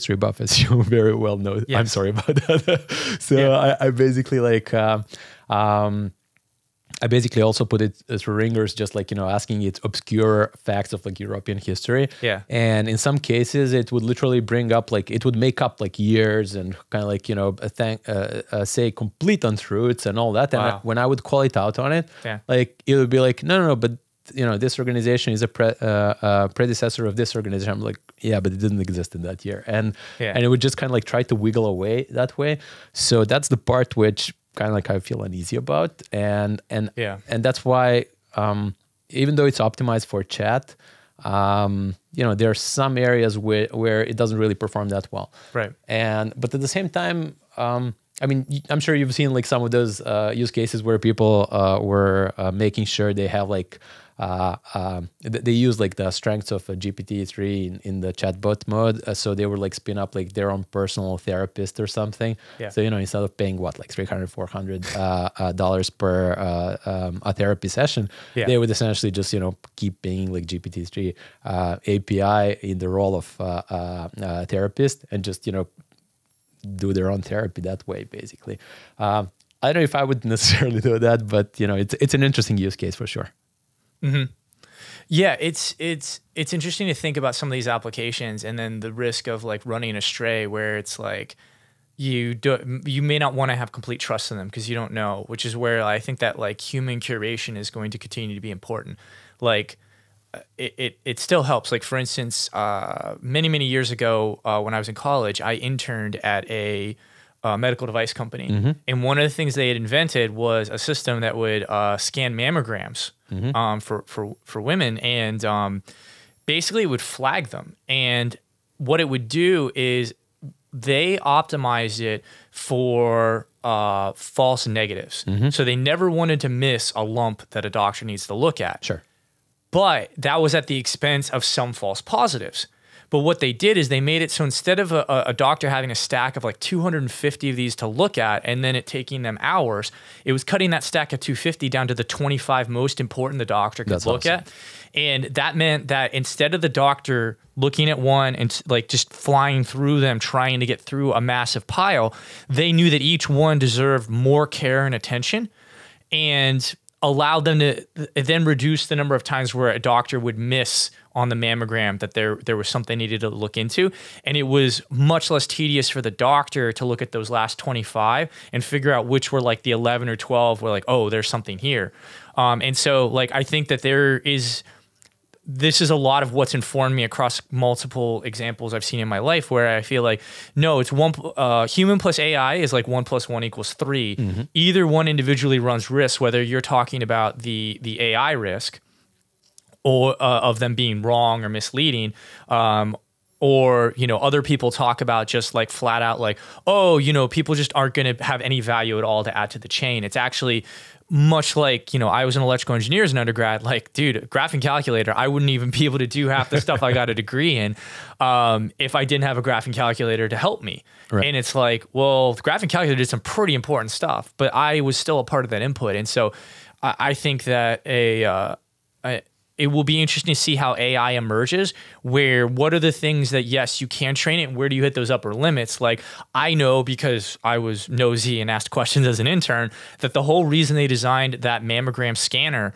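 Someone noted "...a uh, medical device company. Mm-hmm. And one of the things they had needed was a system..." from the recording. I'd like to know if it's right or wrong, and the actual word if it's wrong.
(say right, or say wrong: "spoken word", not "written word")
wrong: "invented", not "needed".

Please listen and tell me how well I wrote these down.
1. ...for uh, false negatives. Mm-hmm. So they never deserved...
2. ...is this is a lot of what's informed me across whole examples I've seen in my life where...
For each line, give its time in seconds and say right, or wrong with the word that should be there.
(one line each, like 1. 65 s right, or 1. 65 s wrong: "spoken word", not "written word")
1. 122 s wrong: "wanted", not "deserved"
2. 174 s wrong: "multiple", not "whole".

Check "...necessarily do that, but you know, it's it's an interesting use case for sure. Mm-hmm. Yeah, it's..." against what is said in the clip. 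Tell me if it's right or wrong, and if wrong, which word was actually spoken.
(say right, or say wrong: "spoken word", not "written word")
right.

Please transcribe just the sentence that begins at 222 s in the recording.
Where what are the things that yes you can train it, and where do you hit those upper limits?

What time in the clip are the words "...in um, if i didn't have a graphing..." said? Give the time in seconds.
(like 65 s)
207 s.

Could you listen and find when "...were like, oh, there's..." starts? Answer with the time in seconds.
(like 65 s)
170 s.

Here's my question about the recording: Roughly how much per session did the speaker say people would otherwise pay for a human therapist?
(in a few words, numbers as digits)
$300 to $400.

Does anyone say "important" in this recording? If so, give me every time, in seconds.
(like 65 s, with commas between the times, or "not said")
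98 s, 142 s, 213 s.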